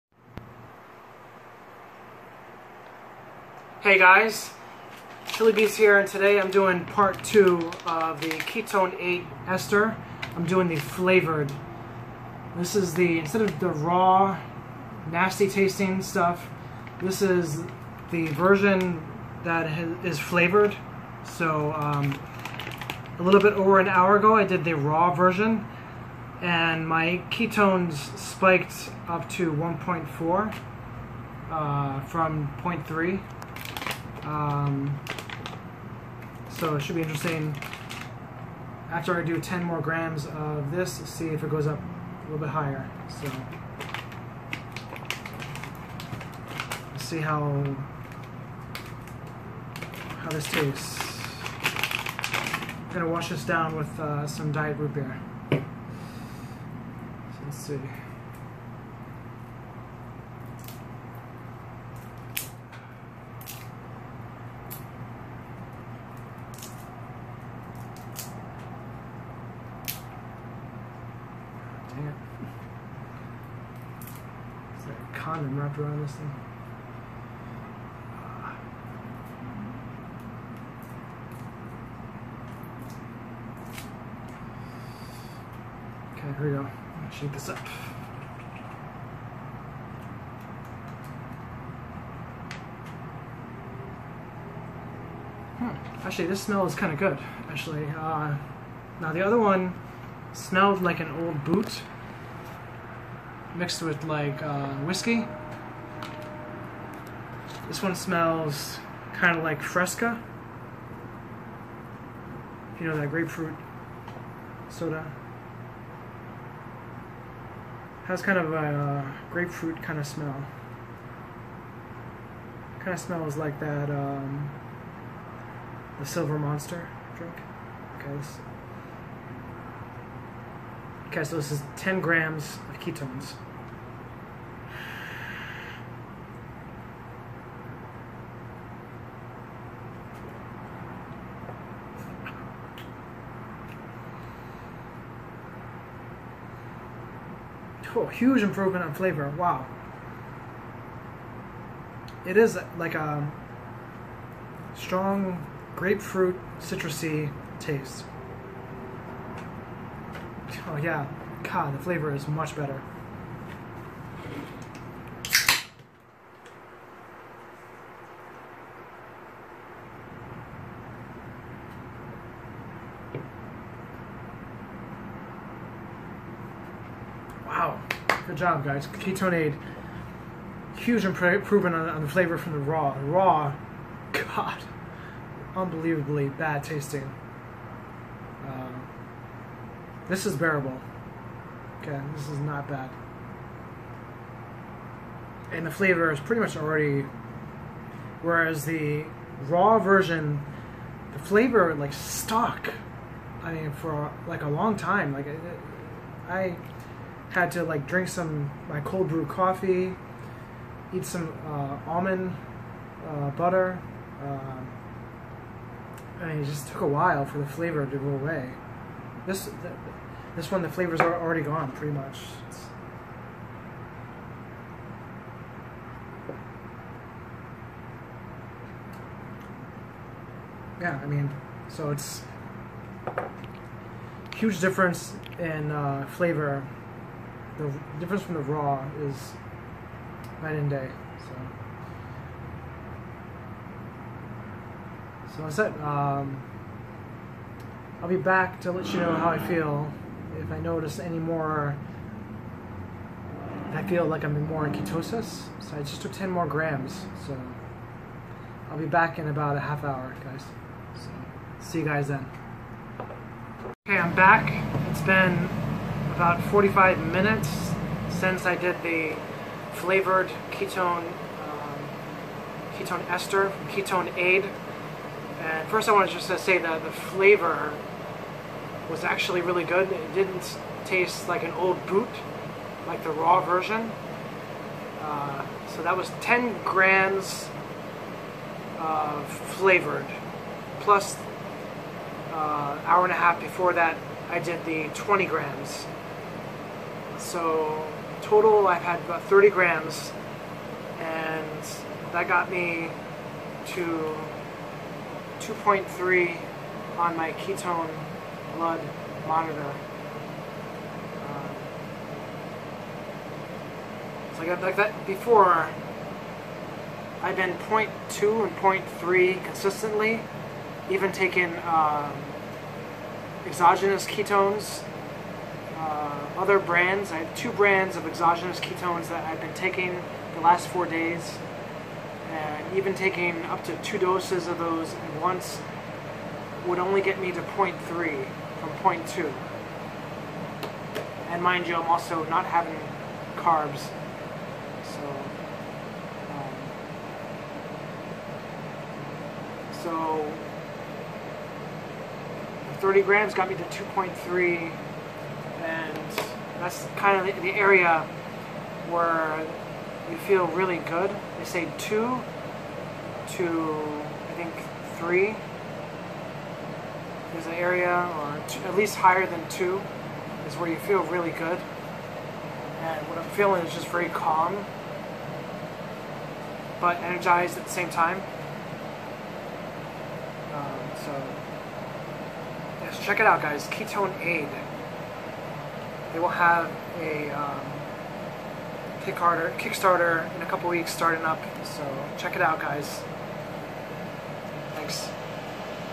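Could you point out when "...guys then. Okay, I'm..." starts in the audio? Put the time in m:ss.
4:21.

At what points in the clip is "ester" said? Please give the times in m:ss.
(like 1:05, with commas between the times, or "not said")
0:09, 4:33.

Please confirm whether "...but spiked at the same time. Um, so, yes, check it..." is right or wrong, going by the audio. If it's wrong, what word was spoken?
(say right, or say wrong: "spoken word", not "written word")
wrong: "energized", not "spiked".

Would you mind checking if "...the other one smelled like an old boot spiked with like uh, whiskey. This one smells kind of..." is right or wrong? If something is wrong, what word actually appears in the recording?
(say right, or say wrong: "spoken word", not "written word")
wrong: "mixed", not "spiked".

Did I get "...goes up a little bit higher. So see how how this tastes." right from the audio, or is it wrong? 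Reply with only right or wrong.
right.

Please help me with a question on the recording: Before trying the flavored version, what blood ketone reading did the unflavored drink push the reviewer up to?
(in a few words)
1.4.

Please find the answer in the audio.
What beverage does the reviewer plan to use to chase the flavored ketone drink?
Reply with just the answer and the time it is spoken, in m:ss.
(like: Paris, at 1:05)
diet root beer, at 0:54.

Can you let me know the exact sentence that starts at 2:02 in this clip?
Kind of smells like that, um, the Silver Monster drink.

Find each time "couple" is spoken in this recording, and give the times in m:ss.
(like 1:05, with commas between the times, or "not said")
6:30.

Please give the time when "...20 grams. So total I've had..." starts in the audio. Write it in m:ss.
4:54.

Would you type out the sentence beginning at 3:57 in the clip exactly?
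The difference from the raw is night and day.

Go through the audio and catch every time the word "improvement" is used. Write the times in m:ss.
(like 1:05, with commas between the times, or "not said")
2:28, 3:01.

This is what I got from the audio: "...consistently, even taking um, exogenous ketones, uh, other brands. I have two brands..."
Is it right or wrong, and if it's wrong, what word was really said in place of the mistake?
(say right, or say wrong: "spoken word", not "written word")
right.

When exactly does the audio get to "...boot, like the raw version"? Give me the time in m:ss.
4:41.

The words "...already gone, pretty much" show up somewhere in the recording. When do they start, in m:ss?
3:41.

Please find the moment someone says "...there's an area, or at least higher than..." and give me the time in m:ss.
6:07.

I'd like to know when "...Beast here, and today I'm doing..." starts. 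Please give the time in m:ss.
0:05.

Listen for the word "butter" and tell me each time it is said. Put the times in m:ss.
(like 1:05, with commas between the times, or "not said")
3:33.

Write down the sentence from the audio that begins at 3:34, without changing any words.
Uh, I mean, it just took a while for the flavor to go away.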